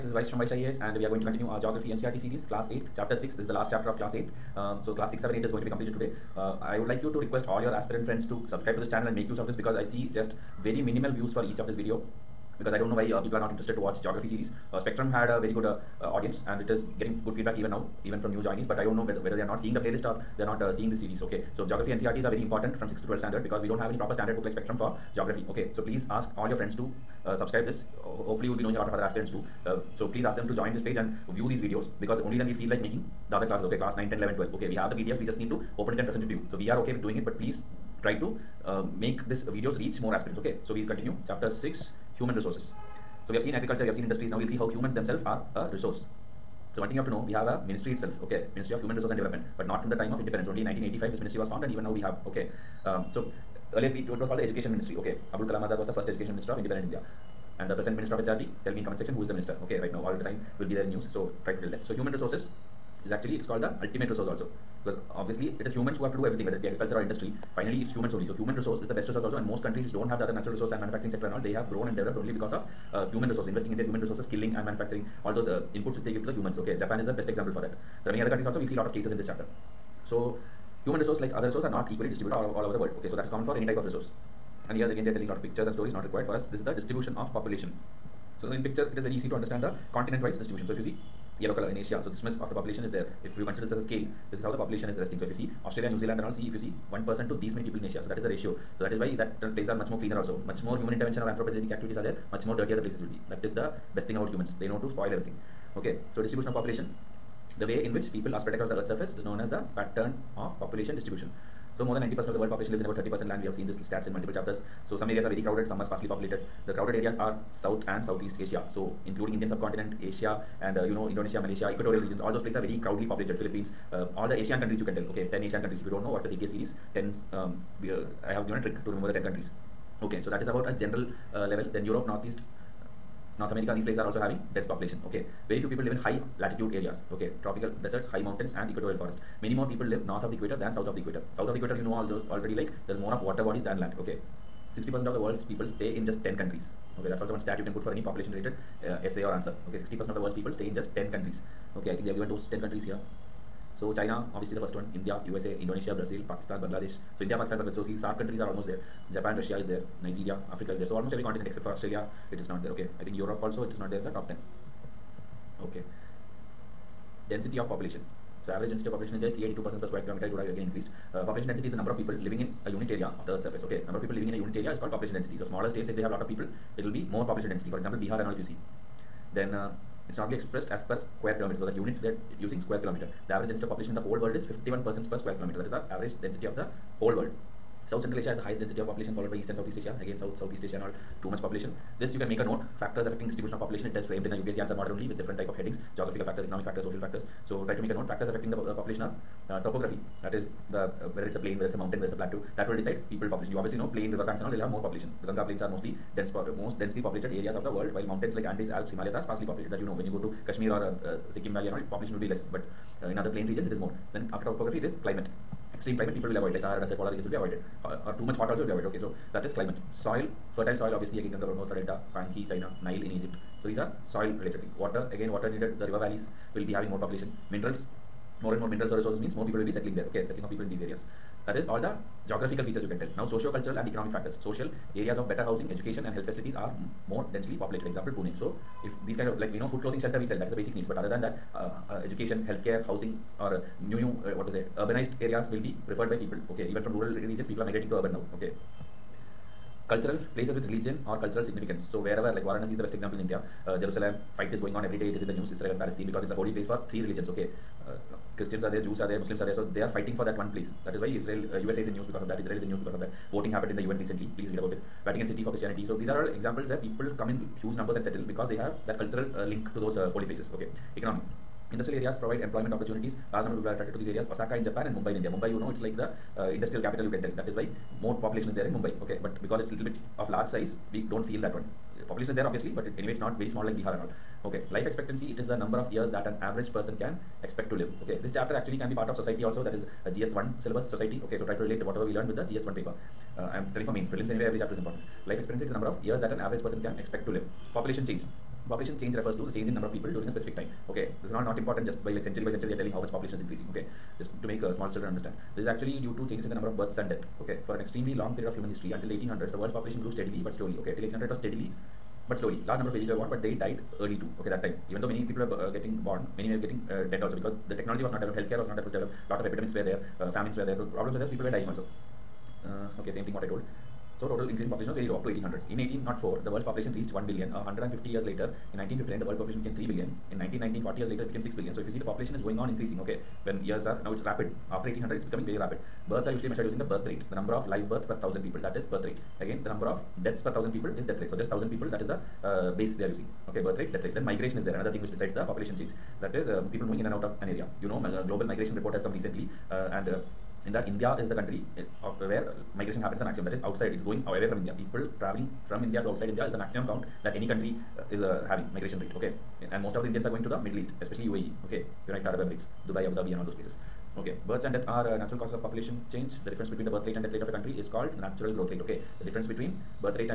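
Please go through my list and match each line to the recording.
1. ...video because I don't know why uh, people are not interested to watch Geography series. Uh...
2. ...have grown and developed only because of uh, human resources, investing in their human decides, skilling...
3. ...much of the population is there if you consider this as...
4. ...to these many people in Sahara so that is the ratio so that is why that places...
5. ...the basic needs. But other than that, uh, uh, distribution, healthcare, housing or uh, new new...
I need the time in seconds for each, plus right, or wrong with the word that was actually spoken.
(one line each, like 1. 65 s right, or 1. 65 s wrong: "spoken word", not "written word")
1. 11 s right
2. 71 s wrong: "resources", not "decides"
3. 92 s right
4. 97 s wrong: "Asia", not "Sahara"
5. 240 s wrong: "education", not "distribution".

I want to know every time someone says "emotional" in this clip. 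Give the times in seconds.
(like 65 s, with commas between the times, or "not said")
not said.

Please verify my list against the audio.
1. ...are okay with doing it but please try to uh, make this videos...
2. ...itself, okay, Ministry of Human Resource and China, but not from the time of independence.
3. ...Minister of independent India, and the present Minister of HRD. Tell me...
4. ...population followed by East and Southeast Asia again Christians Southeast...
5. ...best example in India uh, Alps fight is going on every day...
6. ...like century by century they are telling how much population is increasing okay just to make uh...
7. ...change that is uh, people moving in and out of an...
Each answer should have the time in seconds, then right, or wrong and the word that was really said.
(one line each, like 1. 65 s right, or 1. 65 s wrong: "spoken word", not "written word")
1. 36 s right
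2. 47 s wrong: "Development", not "China"
3. 56 s right
4. 188 s wrong: "South", not "Christians"
5. 252 s wrong: "Jerusalem", not "Alps"
6. 302 s right
7. 345 s right.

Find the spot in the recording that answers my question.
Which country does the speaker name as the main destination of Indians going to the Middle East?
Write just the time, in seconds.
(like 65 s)
361 s.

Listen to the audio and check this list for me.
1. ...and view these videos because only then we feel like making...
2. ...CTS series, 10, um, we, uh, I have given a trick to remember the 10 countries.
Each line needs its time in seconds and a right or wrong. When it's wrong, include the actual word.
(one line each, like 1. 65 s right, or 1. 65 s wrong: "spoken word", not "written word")
1. 30 s right
2. 126 s right.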